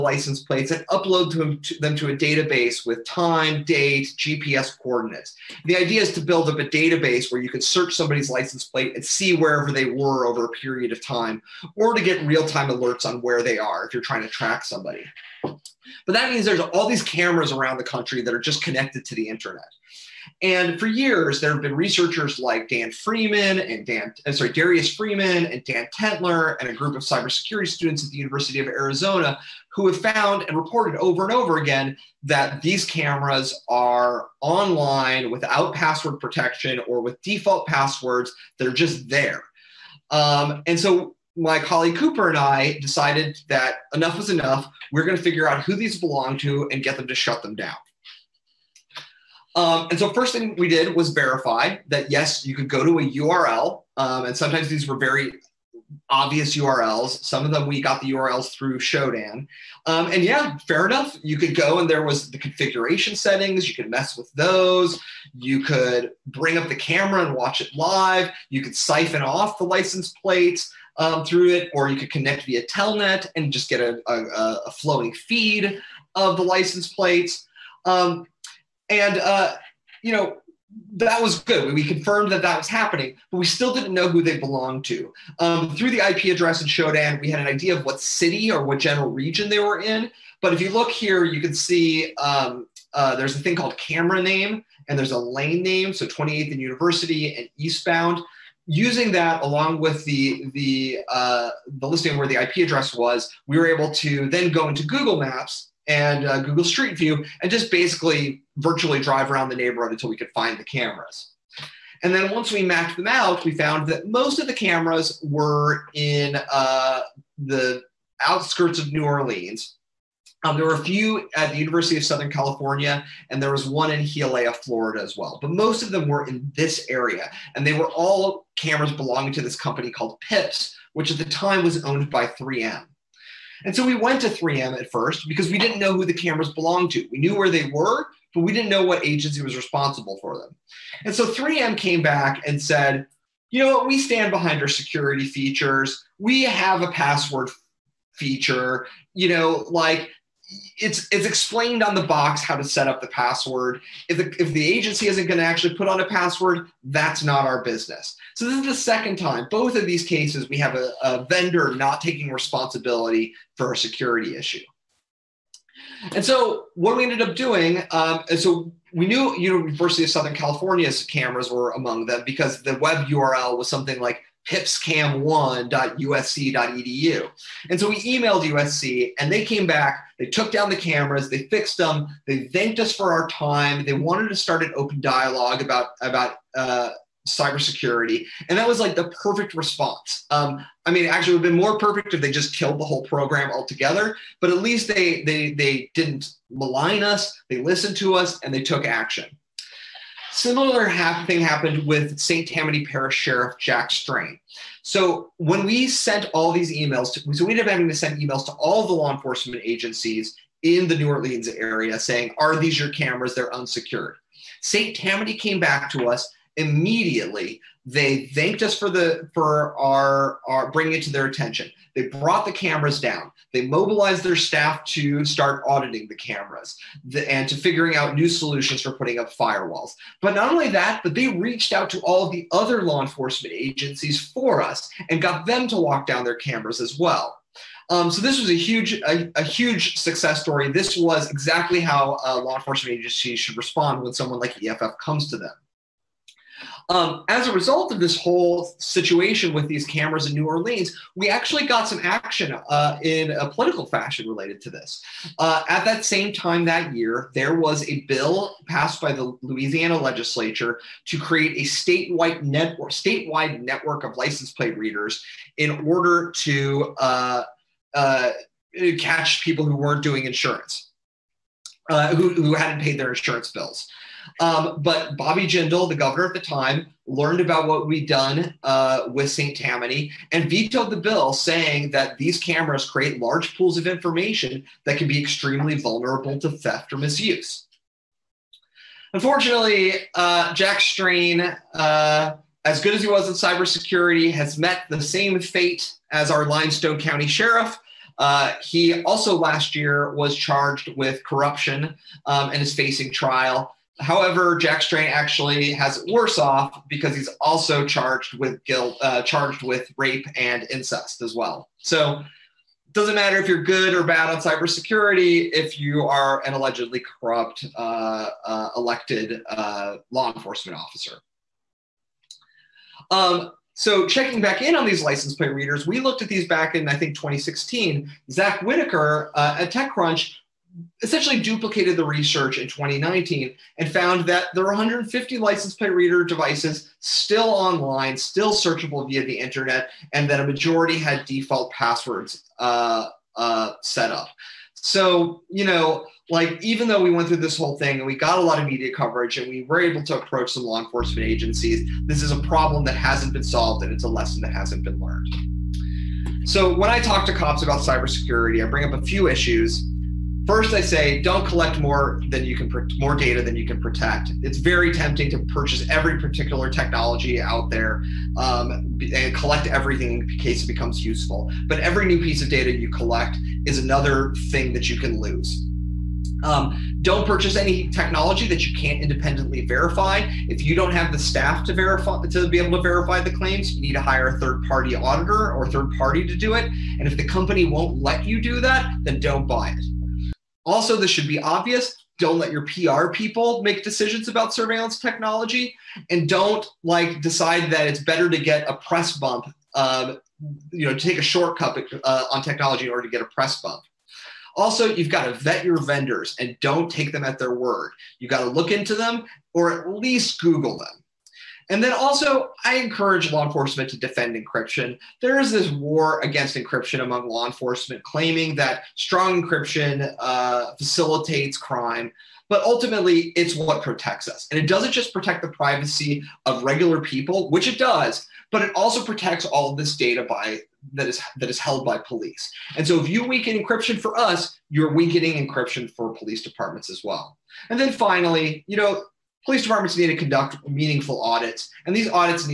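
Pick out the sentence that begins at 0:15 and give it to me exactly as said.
But that means there's all these cameras around the country that are just connected to the internet.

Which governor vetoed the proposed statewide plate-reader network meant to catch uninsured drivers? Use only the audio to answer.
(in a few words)
Bobby Jindal.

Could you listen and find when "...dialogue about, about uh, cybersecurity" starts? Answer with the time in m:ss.
3:05.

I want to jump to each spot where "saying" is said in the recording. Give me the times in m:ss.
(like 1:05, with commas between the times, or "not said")
3:31, 4:41.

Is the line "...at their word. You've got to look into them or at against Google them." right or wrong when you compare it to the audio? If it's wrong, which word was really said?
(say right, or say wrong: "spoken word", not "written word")
wrong: "least", not "against".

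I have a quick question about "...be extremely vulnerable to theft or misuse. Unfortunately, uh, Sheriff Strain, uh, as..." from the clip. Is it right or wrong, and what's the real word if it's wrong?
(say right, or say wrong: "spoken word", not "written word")
wrong: "Jack", not "Sheriff".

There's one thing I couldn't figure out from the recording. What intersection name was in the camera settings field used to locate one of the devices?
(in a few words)
28th and University.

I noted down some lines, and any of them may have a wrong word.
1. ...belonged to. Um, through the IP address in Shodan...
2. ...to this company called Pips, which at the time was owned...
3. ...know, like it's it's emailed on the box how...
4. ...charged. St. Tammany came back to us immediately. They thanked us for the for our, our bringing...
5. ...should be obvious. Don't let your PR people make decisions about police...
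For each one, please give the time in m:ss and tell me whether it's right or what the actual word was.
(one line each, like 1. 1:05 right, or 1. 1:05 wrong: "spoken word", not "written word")
1. 1:24 right
2. 2:09 right
3. 2:29 wrong: "explained", not "emailed"
4. 3:33 wrong: "unsecured", not "charged"
5. 6:31 wrong: "surveillance", not "police".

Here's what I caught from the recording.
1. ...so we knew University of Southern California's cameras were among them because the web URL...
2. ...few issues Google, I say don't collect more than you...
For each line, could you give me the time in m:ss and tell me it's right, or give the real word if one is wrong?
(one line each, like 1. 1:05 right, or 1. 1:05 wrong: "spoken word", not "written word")
1. 2:48 right
2. 5:59 wrong: "First", not "Google".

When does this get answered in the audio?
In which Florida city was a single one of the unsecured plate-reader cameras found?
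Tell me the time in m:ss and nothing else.
2:04.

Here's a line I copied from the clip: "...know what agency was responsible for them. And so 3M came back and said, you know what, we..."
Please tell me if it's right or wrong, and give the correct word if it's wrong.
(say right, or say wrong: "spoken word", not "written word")
right.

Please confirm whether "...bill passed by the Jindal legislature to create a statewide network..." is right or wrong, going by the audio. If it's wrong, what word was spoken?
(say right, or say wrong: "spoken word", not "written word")
wrong: "Louisiana", not "Jindal".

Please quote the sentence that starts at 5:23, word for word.
Um, so, checking back in on these license plate readers, we looked at these back in I think 2016.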